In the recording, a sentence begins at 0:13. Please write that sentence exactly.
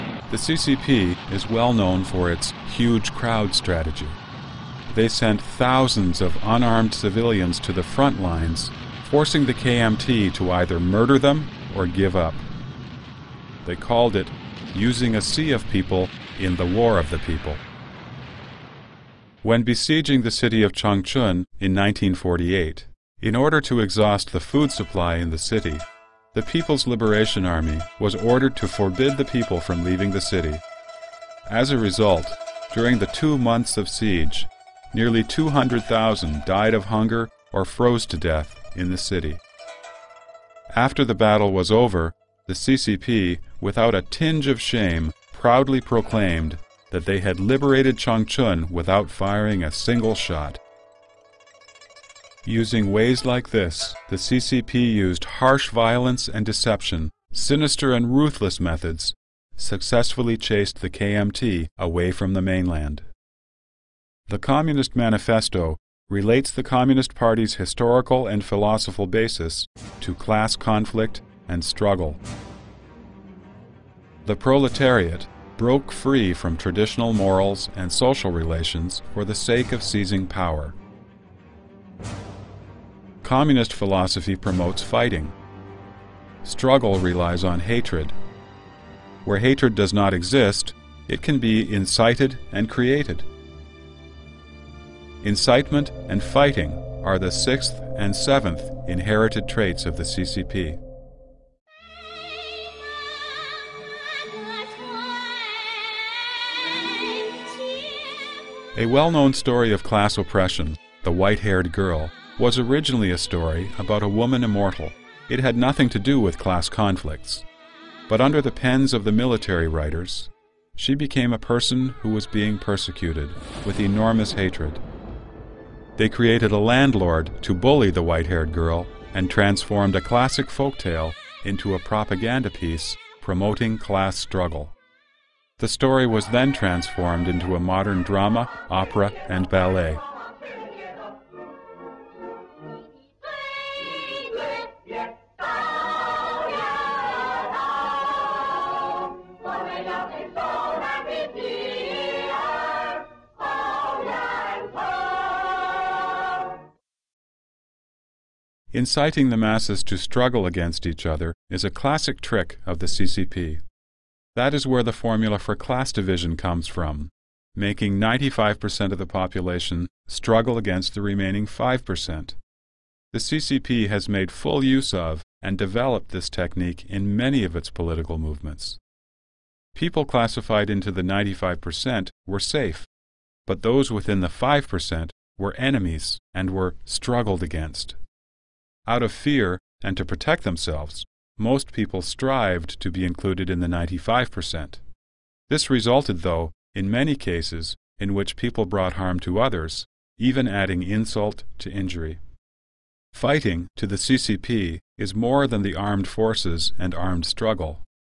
They called it using a sea of people in the war of the people.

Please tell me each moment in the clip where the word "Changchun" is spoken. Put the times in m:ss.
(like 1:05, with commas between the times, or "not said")
0:20, 0:47.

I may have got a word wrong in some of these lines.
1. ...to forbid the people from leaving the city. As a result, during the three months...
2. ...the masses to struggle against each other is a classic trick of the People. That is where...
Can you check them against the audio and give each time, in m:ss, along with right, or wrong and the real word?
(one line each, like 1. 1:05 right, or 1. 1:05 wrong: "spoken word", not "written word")
1. 0:28 wrong: "two", not "three"
2. 2:39 wrong: "CCP", not "People".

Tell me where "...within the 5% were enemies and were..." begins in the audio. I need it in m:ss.
3:03.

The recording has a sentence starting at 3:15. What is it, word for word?
This resulted, though, in many cases in which people brought harm to others, even adding insult to injury.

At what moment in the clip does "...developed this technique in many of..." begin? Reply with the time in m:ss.
2:55.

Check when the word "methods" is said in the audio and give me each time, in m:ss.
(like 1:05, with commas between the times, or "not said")
0:58.